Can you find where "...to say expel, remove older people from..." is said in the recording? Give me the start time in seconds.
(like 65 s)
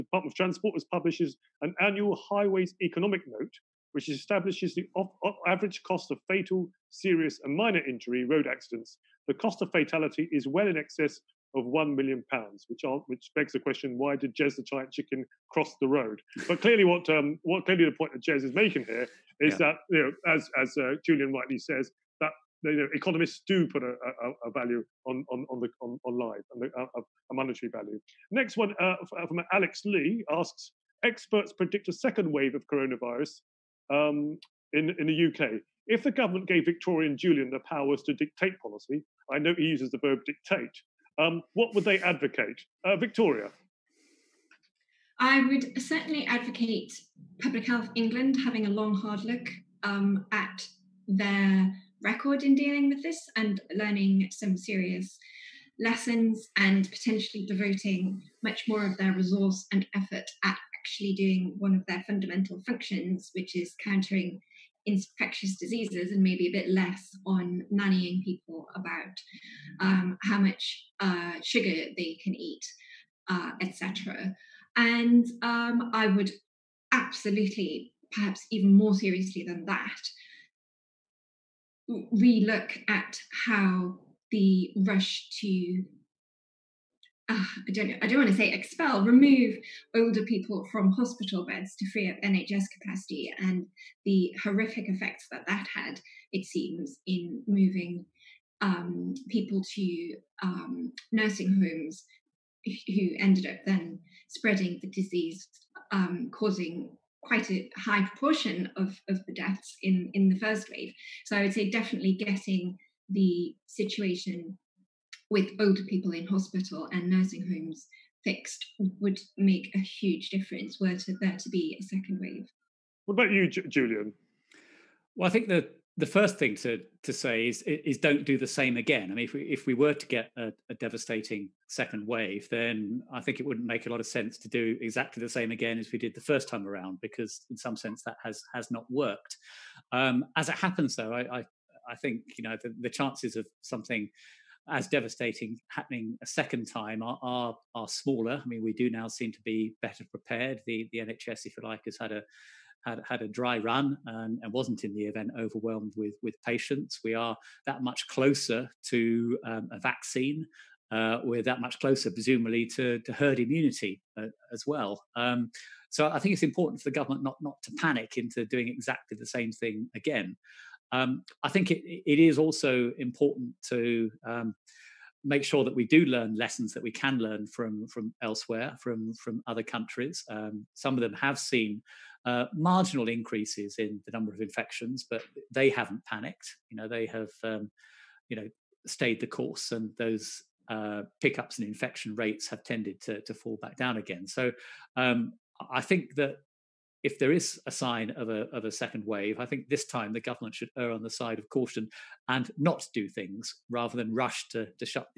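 88 s.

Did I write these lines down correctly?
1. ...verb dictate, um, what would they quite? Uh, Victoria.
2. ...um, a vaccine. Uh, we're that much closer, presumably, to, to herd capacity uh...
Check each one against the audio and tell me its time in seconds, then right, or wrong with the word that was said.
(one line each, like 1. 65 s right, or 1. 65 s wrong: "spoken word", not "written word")
1. 40 s wrong: "advocate", not "quite"
2. 159 s wrong: "immunity", not "capacity".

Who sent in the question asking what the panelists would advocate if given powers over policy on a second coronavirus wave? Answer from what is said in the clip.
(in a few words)
Alex Lee.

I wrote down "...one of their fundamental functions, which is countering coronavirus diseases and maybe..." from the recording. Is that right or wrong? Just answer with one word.
wrong.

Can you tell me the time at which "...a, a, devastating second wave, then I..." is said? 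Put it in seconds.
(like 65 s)
130 s.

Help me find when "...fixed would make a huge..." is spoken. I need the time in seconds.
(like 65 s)
118 s.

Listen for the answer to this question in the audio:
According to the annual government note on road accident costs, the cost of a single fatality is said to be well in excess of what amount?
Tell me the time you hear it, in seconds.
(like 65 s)
11 s.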